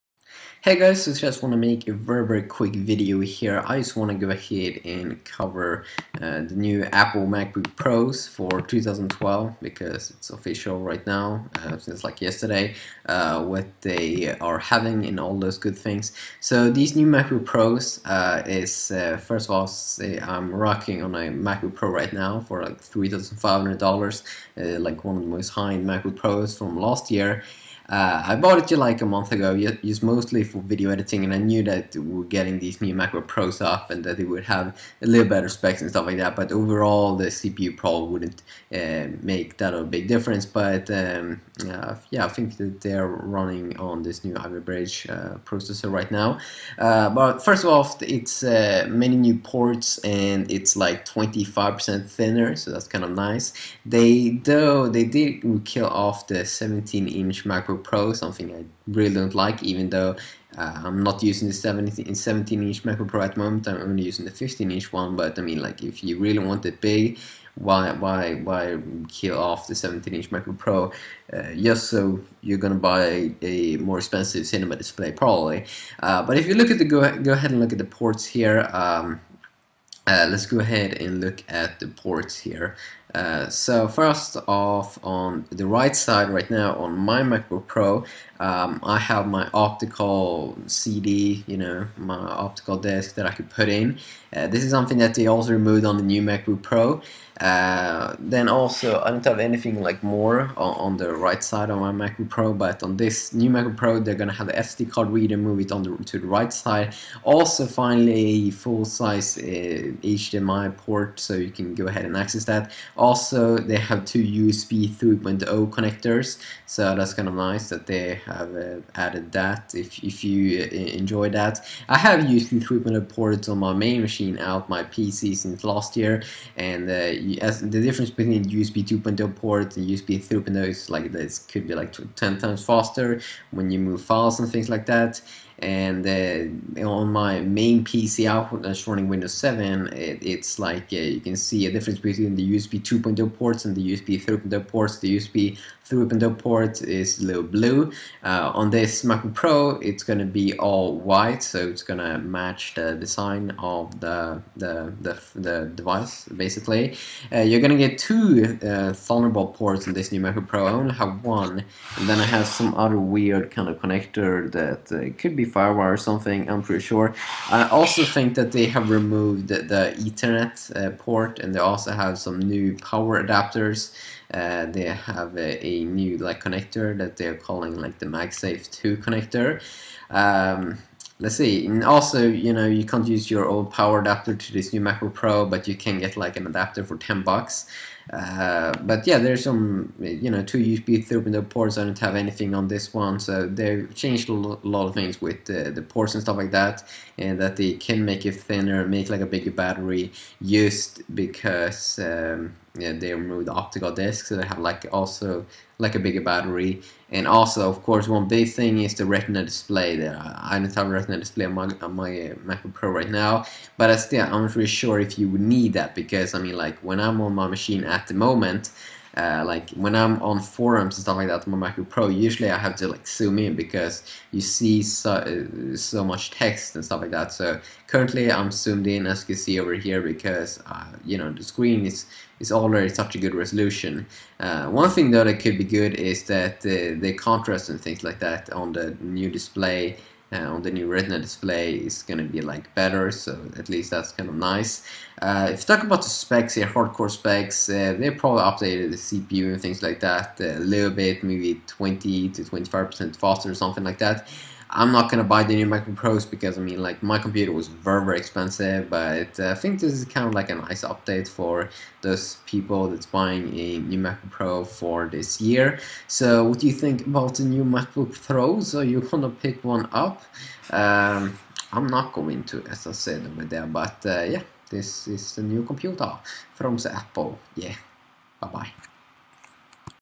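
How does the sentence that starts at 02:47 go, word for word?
I also think that they have removed the, Ethernet uh, port and they also have some new power adapters.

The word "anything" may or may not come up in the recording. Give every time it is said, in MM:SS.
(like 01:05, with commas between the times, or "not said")
01:39, 03:12.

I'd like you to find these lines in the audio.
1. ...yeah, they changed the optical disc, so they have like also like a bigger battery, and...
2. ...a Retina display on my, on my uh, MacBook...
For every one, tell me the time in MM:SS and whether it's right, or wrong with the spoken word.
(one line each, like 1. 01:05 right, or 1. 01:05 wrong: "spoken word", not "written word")
1. 03:22 wrong: "removed", not "changed"
2. 03:30 right.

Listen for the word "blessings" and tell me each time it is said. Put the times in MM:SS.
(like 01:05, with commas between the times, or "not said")
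not said.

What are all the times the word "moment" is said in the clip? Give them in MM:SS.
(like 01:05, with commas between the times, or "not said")
01:03, 03:38.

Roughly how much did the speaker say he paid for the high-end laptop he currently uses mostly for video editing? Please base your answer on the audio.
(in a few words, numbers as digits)
$3,500.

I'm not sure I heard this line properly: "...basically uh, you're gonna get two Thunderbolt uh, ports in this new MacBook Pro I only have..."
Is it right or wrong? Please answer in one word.
right.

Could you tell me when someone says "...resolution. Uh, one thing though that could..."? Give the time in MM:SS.
03:53.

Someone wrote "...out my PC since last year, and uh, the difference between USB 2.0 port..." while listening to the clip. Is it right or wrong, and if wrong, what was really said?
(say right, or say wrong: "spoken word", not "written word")
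right.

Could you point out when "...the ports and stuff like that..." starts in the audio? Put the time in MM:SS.
03:15.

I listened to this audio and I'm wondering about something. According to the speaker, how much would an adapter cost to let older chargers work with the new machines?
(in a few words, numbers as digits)
$10.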